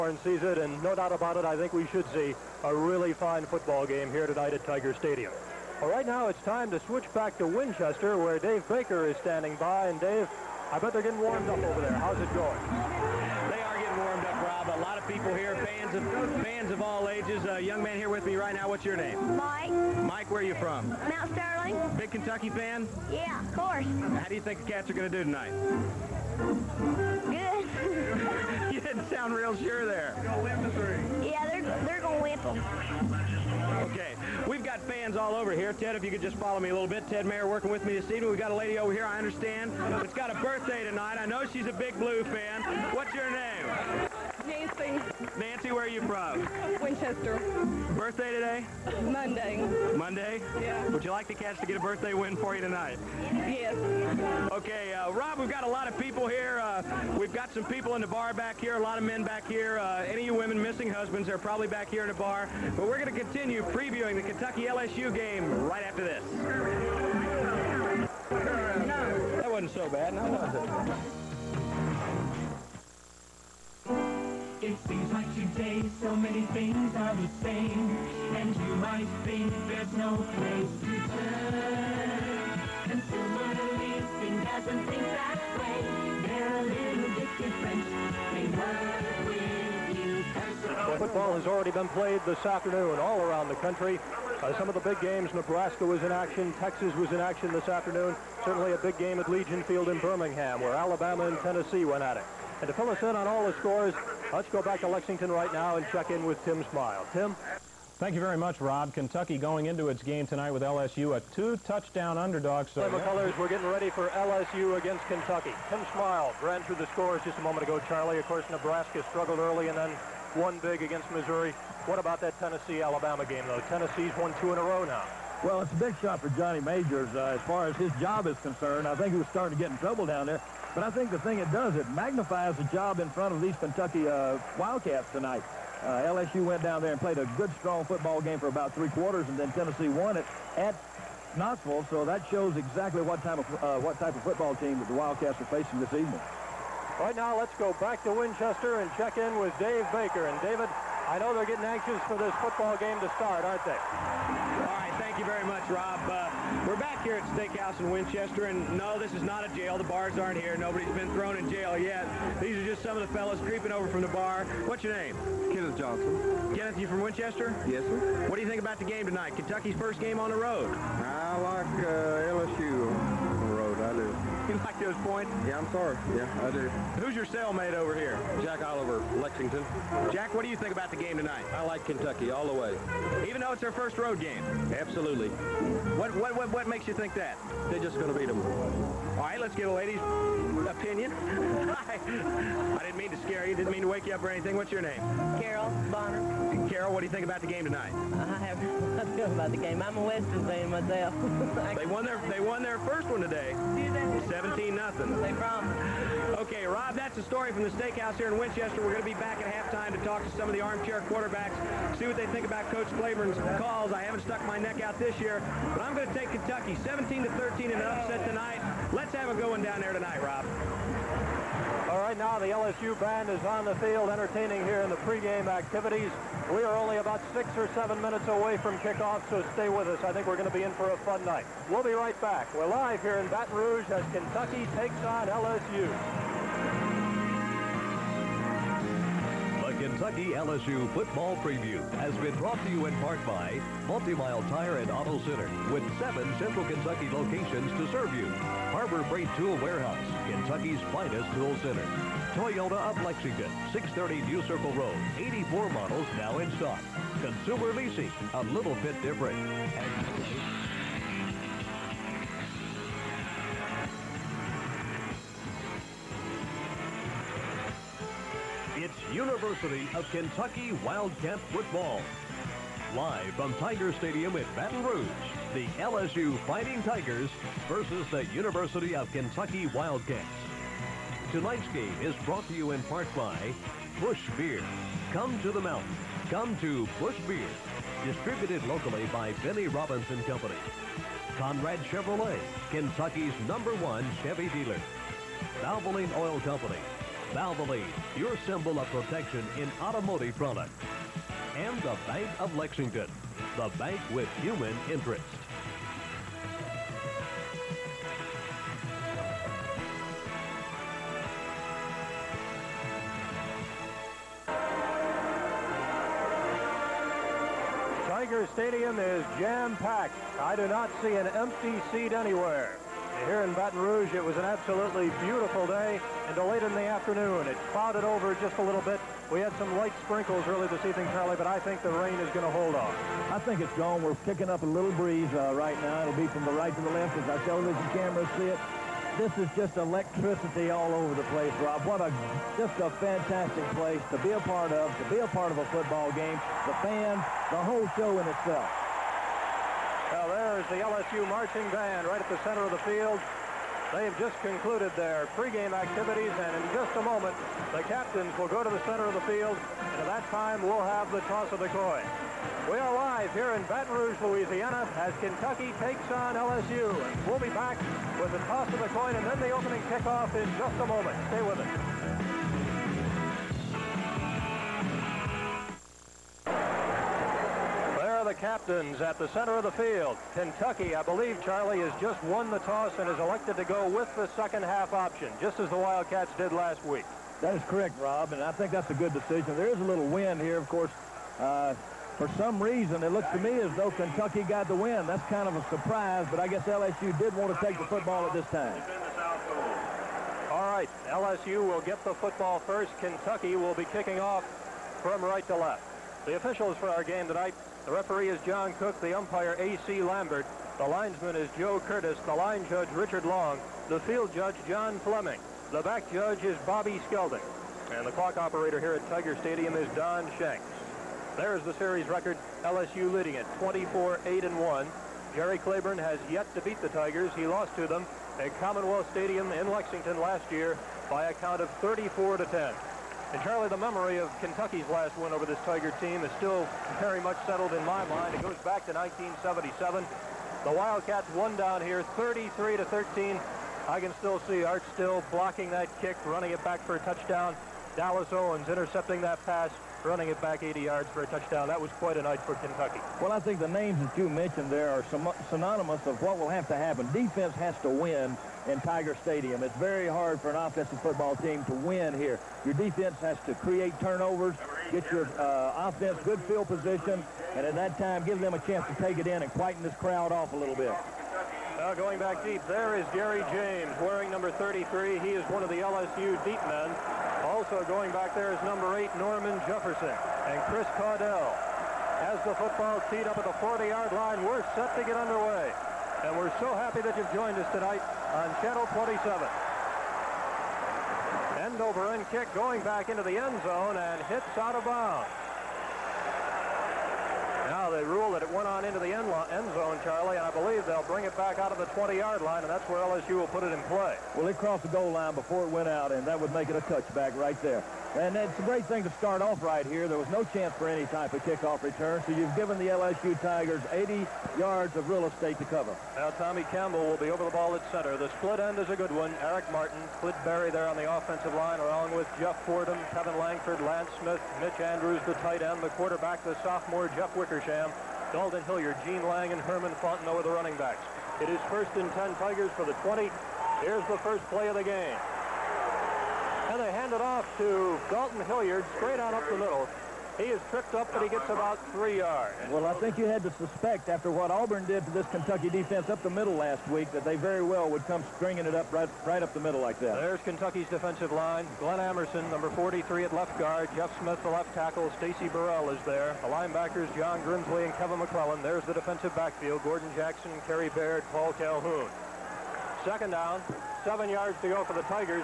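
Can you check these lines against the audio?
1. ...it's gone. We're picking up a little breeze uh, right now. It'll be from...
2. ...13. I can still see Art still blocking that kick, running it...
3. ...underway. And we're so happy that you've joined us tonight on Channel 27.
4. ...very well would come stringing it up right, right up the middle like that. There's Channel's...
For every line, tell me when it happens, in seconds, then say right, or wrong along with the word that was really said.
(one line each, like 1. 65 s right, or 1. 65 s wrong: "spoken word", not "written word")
1. 333 s right
2. 442 s right
3. 485 s right
4. 547 s wrong: "Kentucky", not "Channel".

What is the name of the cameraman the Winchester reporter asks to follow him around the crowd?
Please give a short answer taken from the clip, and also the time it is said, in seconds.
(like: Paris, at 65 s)
Ted Mayer, at 37 s.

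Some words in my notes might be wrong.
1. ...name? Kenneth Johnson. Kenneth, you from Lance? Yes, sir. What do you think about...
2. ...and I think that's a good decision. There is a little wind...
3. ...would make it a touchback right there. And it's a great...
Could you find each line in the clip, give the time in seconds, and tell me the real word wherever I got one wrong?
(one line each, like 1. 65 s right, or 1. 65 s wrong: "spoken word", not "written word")
1. 164 s wrong: "Winchester", not "Lance"
2. 388 s right
3. 506 s right.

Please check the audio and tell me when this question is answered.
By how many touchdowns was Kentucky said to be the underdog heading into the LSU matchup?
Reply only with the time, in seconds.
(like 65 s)
111 s.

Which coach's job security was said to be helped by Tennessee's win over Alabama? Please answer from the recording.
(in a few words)
Johnny Majors.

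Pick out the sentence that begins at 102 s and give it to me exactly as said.
And to fill us in on all the scores, Let's go back to Lexington right now and check in with Tim Smile.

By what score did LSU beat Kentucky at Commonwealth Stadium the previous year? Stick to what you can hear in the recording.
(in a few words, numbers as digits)
34 to 10.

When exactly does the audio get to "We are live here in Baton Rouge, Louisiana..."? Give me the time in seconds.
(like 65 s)
362 s.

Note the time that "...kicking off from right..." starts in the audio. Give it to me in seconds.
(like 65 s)
403 s.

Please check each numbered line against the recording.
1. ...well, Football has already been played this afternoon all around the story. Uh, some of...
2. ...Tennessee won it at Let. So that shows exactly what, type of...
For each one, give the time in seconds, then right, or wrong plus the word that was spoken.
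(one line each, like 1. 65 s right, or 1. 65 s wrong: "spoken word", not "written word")
1. 90 s wrong: "country", not "story"
2. 139 s wrong: "Knoxville", not "Let".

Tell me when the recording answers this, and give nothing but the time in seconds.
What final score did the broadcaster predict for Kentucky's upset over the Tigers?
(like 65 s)
216 s.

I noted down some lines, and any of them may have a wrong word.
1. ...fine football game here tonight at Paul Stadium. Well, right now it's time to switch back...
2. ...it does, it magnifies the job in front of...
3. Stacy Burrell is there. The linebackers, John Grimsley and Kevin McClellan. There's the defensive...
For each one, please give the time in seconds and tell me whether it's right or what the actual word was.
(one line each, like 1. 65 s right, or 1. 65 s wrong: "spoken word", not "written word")
1. 3 s wrong: "Tiger", not "Paul"
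2. 131 s right
3. 555 s right.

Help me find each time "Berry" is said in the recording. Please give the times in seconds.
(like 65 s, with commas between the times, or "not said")
520 s.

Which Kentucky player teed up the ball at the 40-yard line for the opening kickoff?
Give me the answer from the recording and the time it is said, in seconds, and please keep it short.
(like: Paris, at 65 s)
Chris Caudell, at 480 s.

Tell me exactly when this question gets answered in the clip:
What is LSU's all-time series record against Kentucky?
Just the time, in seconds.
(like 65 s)
423 s.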